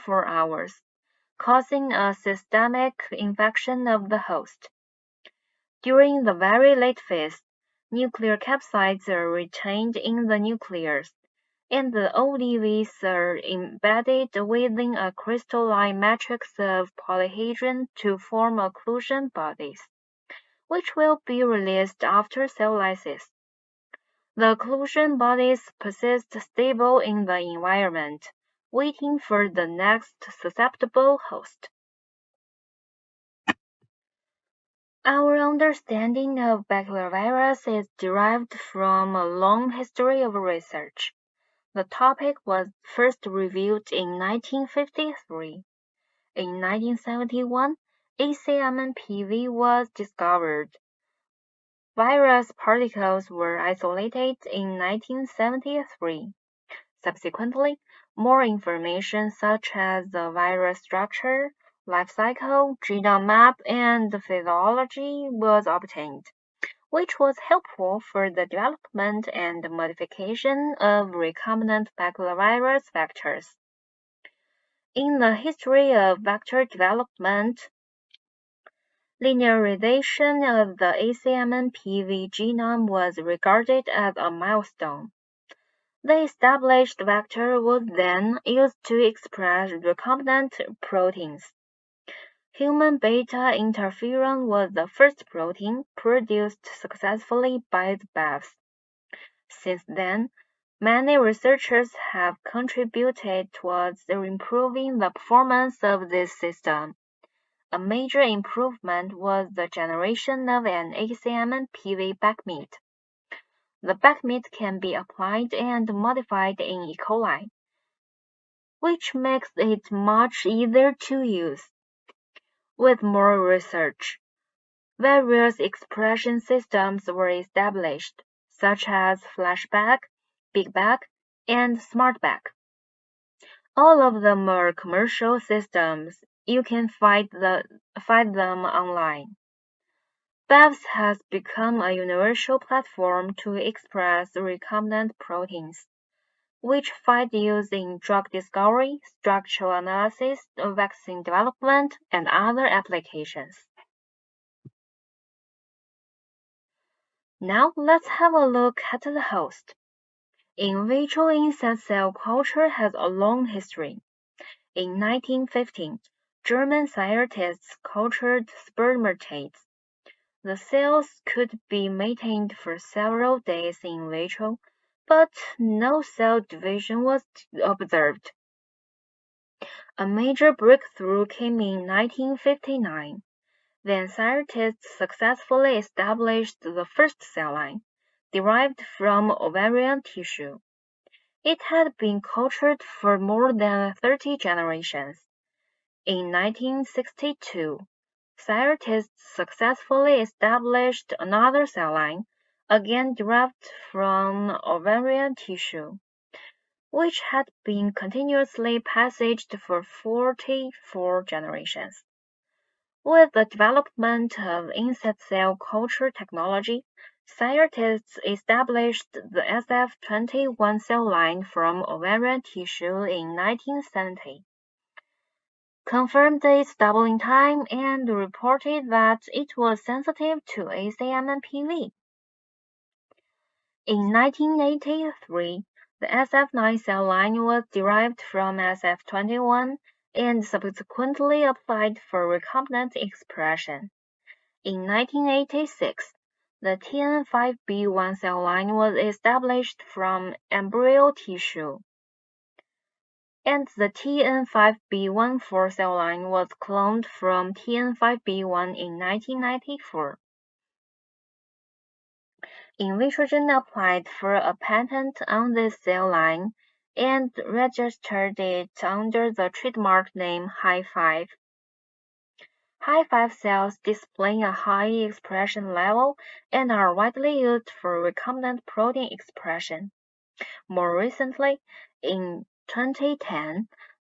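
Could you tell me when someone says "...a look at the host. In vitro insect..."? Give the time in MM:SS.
02:38.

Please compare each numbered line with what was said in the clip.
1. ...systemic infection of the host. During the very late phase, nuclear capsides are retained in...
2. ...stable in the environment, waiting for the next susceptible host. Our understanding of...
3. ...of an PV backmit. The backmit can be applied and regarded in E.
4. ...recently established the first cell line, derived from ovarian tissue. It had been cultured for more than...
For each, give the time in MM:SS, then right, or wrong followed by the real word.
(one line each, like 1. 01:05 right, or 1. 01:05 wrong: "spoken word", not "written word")
1. 00:02 right
2. 00:26 right
3. 01:50 wrong: "modified", not "regarded"
4. 03:04 wrong: "successfully", not "recently".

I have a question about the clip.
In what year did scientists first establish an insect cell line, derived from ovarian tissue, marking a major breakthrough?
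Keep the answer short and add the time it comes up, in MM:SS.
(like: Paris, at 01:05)
1959, at 03:01.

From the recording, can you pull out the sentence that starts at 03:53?
In 1983, the SF9 cell line was derived from SF21 and subsequently applied for recombinant expression.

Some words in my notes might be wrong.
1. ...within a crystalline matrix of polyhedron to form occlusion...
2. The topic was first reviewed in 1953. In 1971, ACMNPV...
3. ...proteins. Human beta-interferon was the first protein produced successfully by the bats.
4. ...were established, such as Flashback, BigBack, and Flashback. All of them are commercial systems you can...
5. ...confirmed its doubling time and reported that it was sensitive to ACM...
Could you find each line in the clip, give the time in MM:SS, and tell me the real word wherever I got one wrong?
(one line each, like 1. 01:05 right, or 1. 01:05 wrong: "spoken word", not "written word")
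1. 00:14 right
2. 00:41 right
3. 01:30 right
4. 02:07 wrong: "SmartBack", not "Flashback"
5. 03:45 right.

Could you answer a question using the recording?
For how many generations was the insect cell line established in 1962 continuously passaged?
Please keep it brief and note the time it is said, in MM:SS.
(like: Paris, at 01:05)
44, at 03:29.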